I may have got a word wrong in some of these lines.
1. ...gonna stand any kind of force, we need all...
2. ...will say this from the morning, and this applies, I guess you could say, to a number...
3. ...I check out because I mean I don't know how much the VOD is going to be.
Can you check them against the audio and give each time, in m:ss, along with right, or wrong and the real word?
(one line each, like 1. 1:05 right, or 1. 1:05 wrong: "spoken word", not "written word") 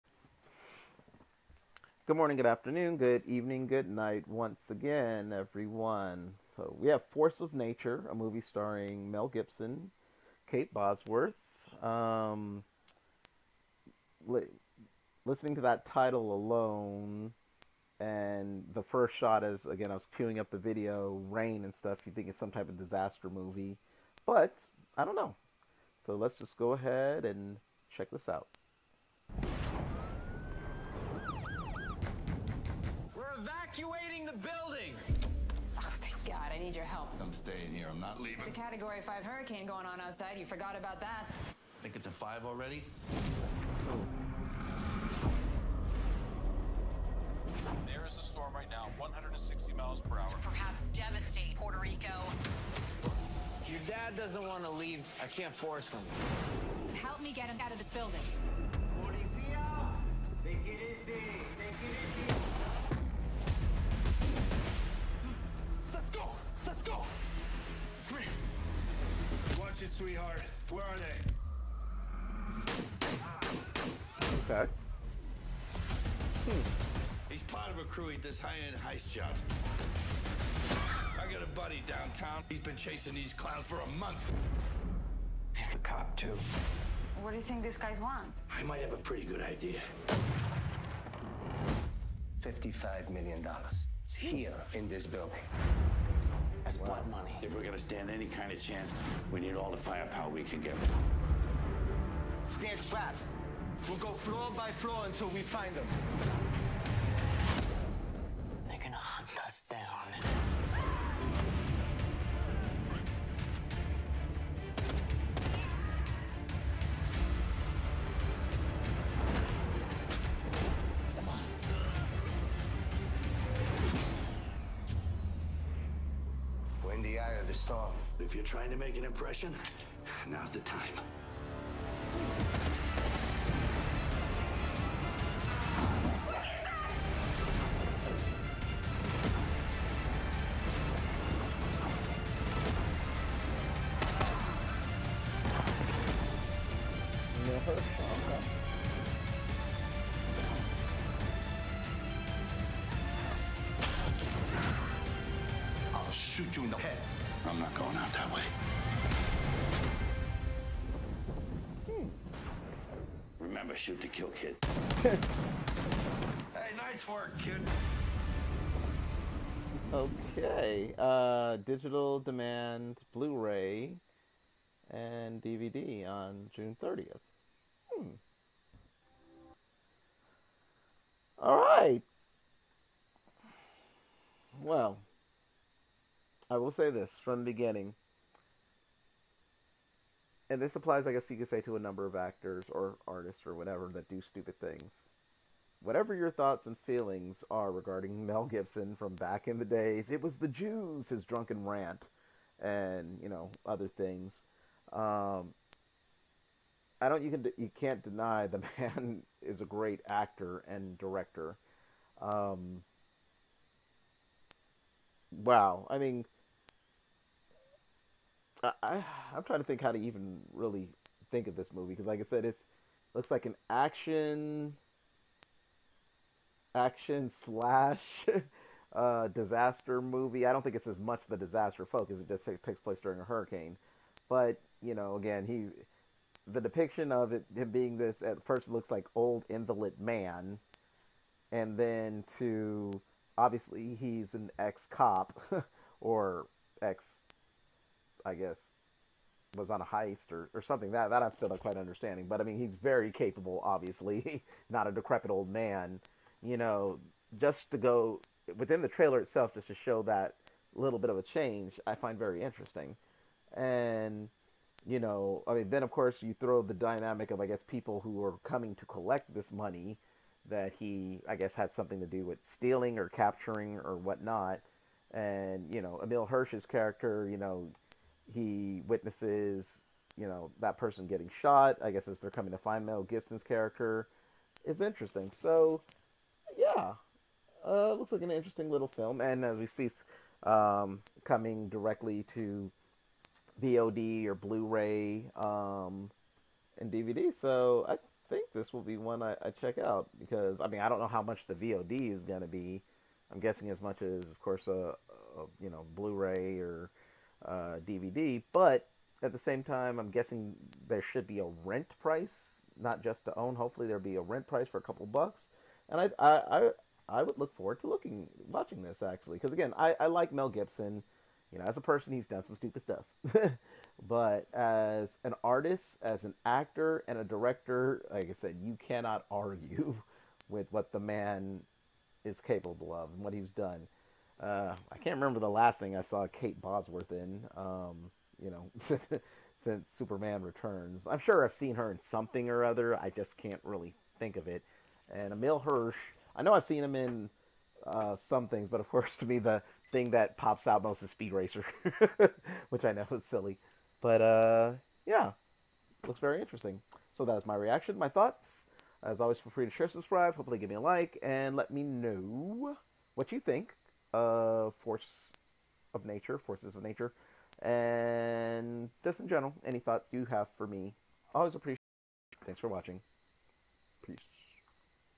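1. 1:37 wrong: "chance", not "force"
2. 3:06 wrong: "beginning", not "morning"
3. 4:59 right.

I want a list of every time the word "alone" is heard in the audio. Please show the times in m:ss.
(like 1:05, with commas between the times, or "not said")
0:16.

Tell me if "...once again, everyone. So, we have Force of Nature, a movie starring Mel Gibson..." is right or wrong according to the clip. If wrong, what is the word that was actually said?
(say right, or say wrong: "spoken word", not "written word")
right.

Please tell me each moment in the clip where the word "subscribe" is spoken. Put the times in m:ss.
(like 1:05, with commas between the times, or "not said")
5:59.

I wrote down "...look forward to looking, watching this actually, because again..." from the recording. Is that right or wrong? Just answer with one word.
right.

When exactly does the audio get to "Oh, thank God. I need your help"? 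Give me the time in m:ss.
0:35.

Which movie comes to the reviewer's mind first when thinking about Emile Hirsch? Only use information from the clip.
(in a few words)
Speed Racer.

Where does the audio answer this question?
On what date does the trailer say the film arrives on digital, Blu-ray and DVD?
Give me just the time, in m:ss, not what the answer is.
2:56.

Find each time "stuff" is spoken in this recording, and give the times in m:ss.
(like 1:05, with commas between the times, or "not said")
0:21, 5:22.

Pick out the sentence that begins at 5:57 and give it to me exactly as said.
So that is my reaction, my thoughts.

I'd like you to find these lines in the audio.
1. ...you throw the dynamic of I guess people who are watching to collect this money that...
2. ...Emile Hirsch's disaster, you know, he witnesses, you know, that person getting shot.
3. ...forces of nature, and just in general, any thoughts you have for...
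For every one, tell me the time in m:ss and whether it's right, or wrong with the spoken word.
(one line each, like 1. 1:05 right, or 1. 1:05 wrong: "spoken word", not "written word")
1. 4:26 wrong: "coming", not "watching"
2. 4:36 wrong: "character", not "disaster"
3. 6:06 right.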